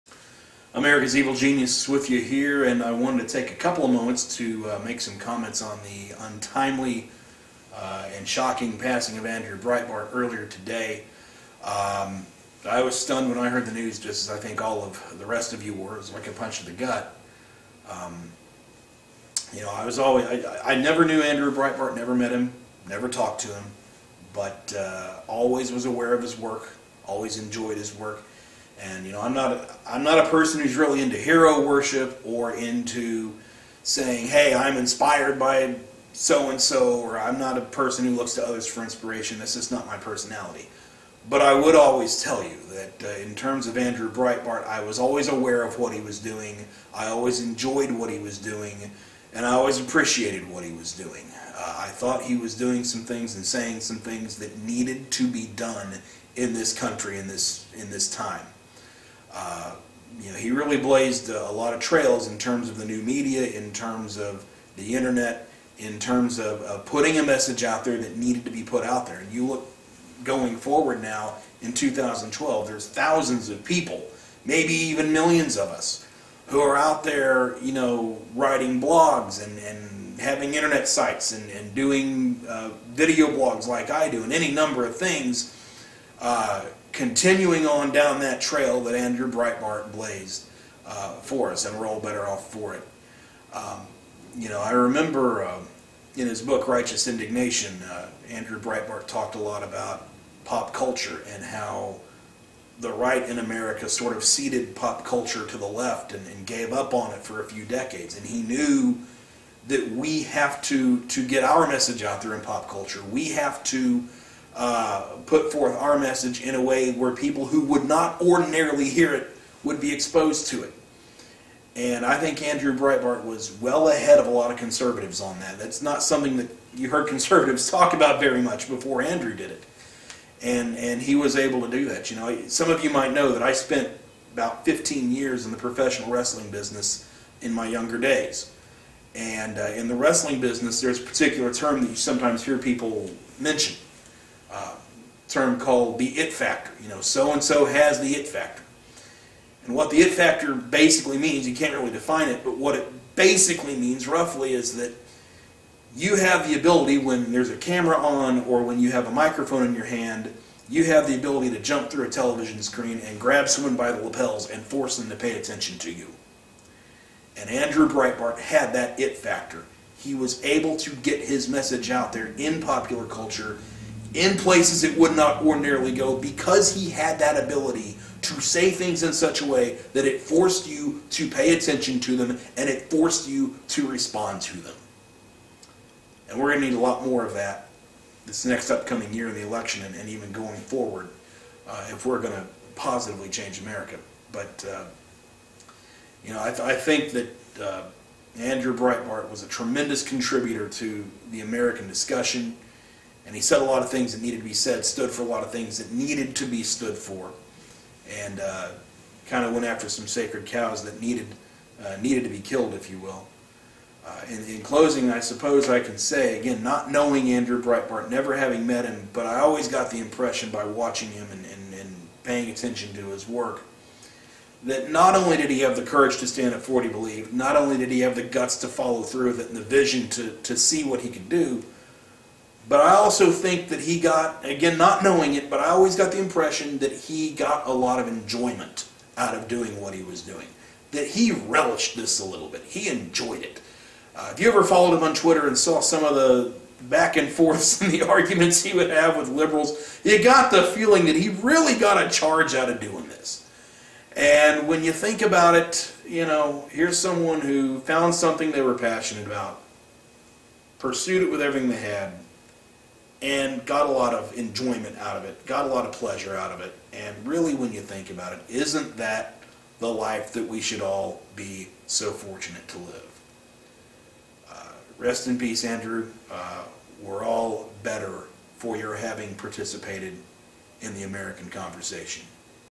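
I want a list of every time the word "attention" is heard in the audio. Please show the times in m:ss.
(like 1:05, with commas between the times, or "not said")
2:45, 3:01, 3:42.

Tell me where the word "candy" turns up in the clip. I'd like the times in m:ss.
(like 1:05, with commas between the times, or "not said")
not said.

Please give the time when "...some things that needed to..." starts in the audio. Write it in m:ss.
0:53.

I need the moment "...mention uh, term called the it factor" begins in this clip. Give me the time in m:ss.
2:23.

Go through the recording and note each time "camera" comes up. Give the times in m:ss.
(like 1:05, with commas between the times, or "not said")
2:37.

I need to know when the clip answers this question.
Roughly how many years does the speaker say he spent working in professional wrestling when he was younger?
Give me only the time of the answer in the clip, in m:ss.
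2:14.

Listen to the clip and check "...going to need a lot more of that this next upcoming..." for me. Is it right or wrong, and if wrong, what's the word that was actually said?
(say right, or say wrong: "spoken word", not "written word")
right.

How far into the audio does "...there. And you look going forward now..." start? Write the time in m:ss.
1:09.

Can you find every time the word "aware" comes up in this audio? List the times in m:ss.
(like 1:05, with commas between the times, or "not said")
0:25, 0:45.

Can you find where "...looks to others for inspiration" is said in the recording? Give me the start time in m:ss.
0:38.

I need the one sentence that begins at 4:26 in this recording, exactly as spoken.
And really, when you think about it, isn't that the life that we should all be so fortunate to live?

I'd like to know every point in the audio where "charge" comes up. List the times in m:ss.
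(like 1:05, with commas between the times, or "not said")
4:12.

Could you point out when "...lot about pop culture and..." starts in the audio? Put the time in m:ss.
1:39.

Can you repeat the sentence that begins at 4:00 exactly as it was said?
That he relished this a little bit.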